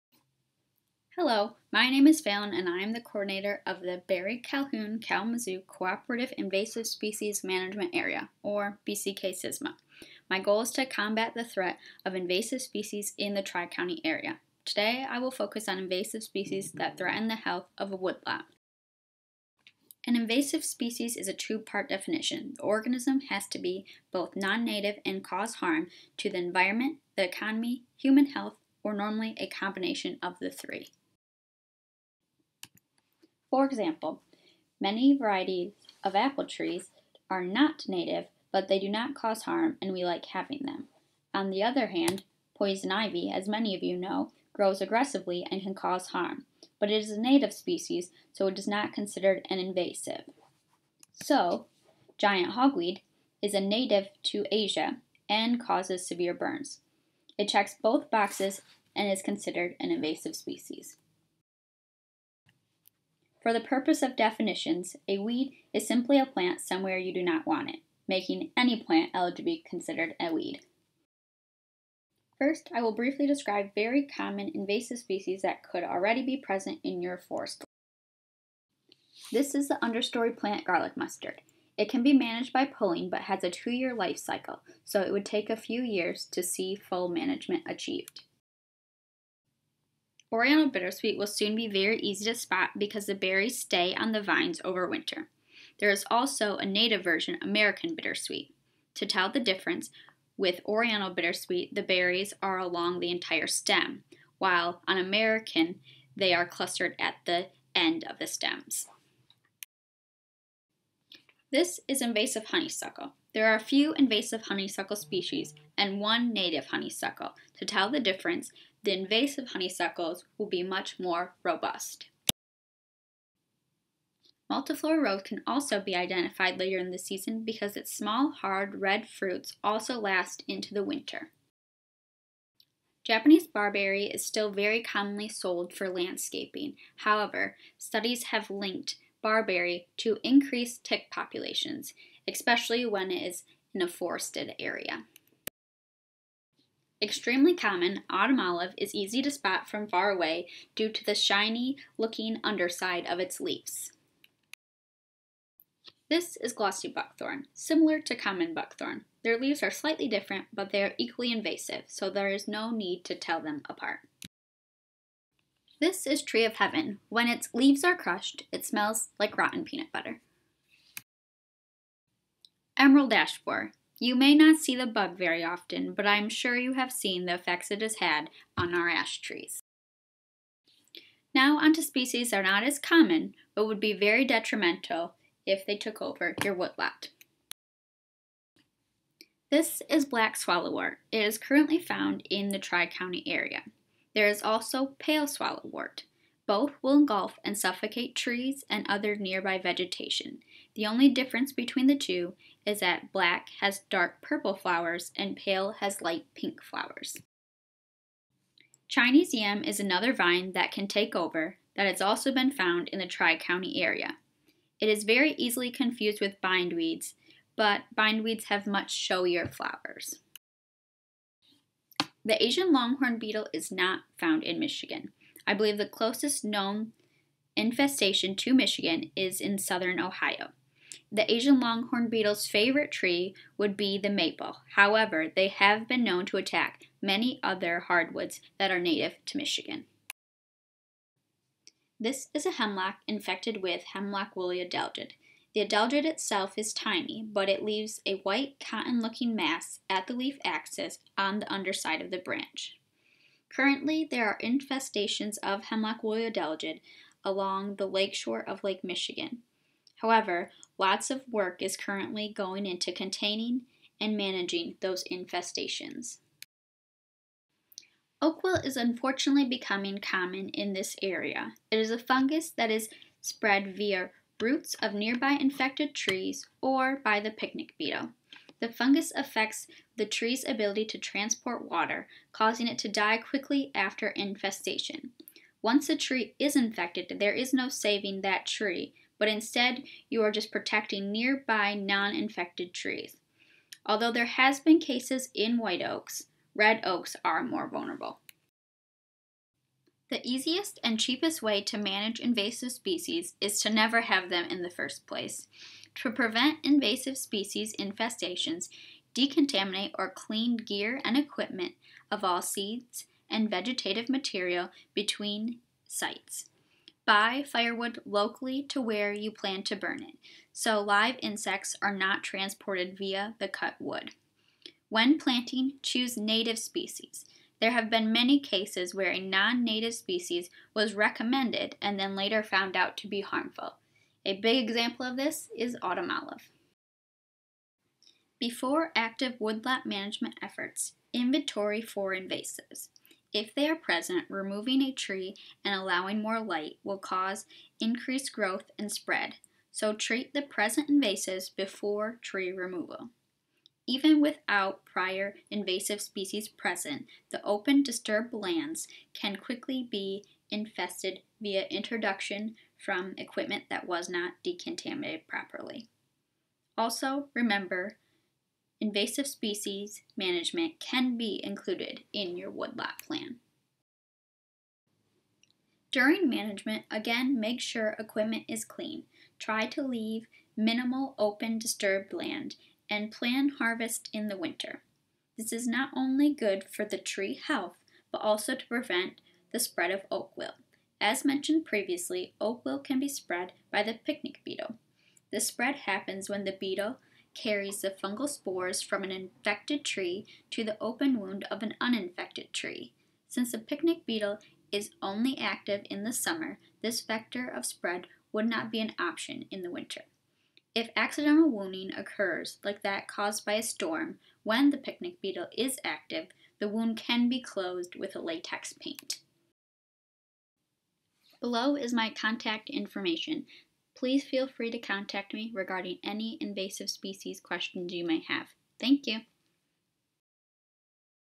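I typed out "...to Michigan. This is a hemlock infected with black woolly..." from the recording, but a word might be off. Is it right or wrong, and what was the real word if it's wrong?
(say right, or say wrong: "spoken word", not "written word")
wrong: "hemlock", not "black".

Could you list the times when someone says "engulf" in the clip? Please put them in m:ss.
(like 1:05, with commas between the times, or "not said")
3:16.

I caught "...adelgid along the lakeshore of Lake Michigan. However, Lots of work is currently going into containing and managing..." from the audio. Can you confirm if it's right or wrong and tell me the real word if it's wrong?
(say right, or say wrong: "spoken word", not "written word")
right.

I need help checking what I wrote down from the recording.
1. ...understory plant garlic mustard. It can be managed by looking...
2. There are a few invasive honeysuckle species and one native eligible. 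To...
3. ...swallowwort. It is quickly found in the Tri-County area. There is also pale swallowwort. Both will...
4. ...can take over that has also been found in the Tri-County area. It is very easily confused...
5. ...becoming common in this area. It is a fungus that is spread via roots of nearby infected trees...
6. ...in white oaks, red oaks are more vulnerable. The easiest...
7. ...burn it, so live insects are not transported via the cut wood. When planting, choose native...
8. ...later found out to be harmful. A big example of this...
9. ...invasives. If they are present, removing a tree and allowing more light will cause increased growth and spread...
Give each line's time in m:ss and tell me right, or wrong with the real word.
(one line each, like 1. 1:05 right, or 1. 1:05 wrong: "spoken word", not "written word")
1. 1:19 wrong: "pulling", not "looking"
2. 1:53 wrong: "honeysuckle", not "eligible"
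3. 3:10 wrong: "currently", not "quickly"
4. 3:30 right
5. 4:29 right
6. 4:55 right
7. 5:19 right
8. 5:32 right
9. 5:42 right.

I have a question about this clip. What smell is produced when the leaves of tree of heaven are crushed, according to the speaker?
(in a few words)
Rotten peanut butter.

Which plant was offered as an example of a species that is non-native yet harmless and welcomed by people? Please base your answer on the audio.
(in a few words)
Apple trees.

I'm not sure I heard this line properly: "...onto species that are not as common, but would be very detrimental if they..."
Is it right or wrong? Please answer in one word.
right.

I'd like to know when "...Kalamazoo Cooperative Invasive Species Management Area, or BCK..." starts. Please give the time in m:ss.
0:04.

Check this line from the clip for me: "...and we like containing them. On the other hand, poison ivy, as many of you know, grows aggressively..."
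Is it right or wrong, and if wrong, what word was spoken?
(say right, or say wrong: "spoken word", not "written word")
wrong: "having", not "containing".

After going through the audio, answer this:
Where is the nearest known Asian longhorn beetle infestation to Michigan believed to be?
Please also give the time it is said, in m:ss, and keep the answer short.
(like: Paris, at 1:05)
Southern Ohio, at 3:49.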